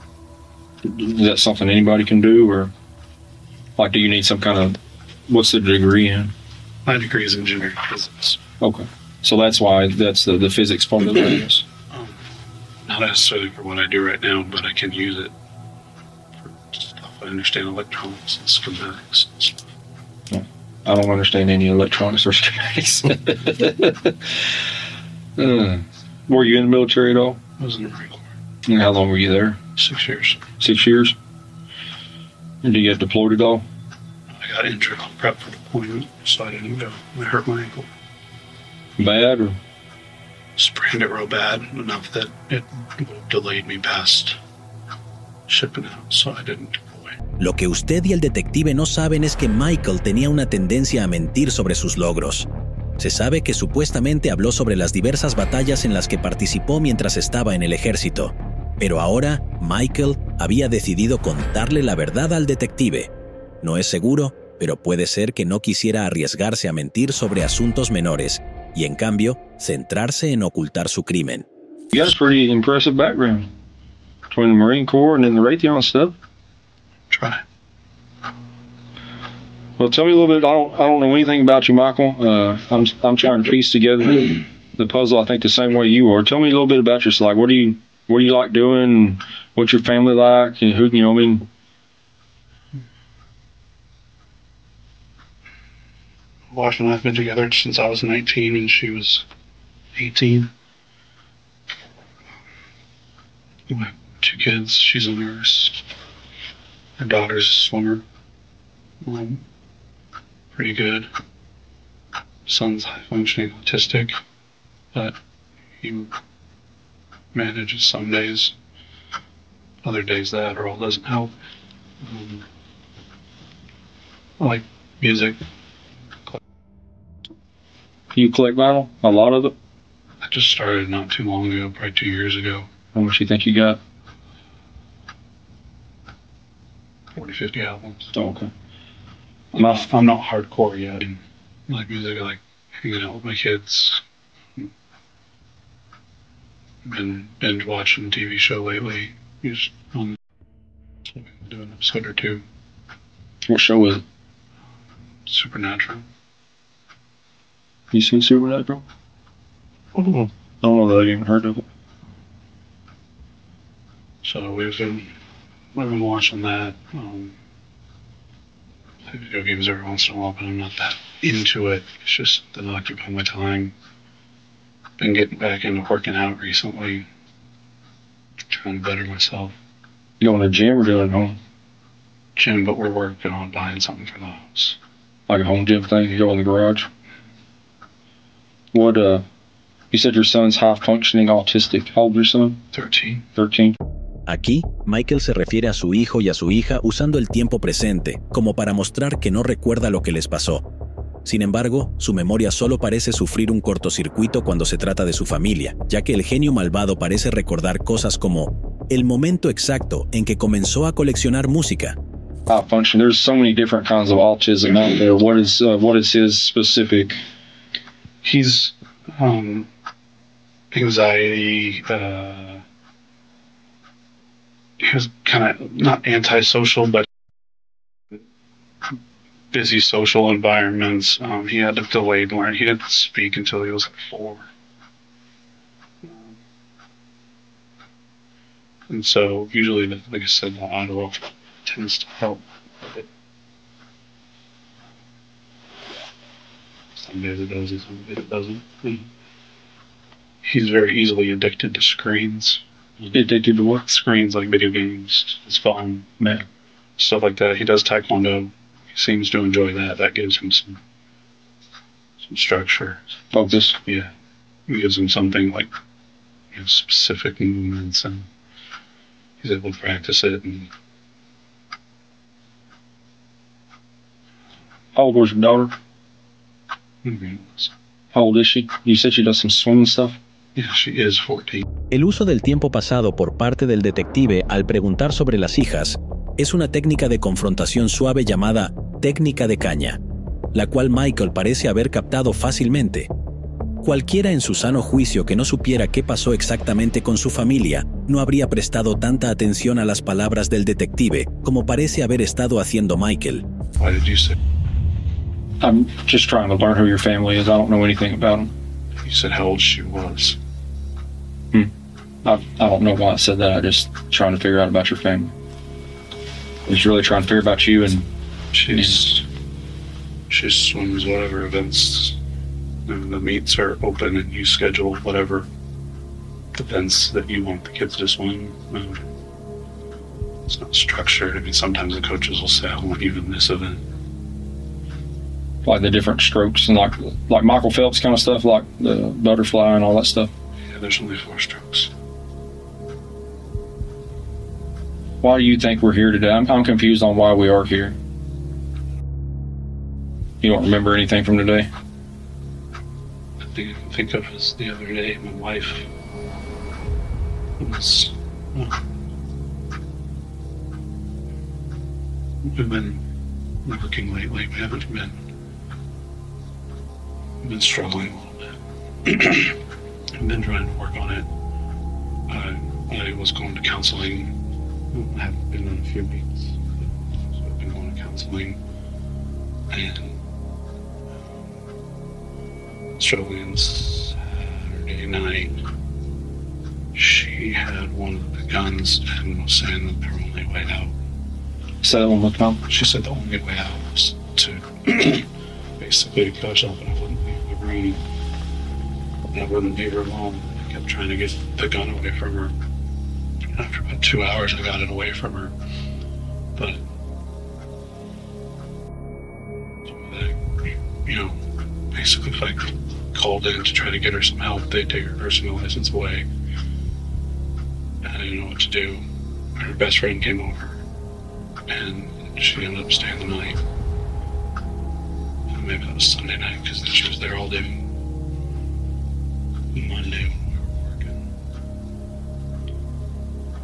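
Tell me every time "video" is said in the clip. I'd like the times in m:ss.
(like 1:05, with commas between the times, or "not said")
2:49, 4:14.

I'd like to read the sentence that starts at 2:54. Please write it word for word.
Been getting back into working out recently, trying to better myself.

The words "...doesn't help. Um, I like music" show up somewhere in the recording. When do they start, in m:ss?
2:00.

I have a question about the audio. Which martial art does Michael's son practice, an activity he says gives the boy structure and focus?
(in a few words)
Taekwondo.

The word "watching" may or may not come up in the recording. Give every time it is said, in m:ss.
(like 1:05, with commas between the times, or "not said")
2:27, 2:46.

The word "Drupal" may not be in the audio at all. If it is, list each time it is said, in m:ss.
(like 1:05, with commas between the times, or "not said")
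not said.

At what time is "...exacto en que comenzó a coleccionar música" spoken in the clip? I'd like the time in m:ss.
3:29.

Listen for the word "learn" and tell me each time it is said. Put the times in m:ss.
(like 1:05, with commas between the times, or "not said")
3:52, 5:06.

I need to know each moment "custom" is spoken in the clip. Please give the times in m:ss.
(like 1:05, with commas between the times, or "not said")
not said.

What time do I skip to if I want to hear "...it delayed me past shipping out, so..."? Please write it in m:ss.
0:42.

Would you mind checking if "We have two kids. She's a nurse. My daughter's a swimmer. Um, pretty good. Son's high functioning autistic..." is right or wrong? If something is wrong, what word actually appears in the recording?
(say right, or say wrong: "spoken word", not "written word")
right.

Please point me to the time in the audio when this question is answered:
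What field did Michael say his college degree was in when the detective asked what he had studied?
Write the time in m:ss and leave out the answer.
0:07.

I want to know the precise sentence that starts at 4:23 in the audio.
Yeah, it gives him something like you know, specific movements, and he's able to practice it.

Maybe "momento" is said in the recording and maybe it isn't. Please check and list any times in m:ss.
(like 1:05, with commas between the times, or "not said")
3:29.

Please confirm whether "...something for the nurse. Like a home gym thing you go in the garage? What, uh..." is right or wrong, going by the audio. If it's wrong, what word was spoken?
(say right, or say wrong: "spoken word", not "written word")
wrong: "house", not "nurse".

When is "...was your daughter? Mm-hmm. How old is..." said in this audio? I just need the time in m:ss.
4:35.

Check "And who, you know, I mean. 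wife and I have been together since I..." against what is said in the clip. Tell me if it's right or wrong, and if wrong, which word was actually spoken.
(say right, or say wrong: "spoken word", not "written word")
right.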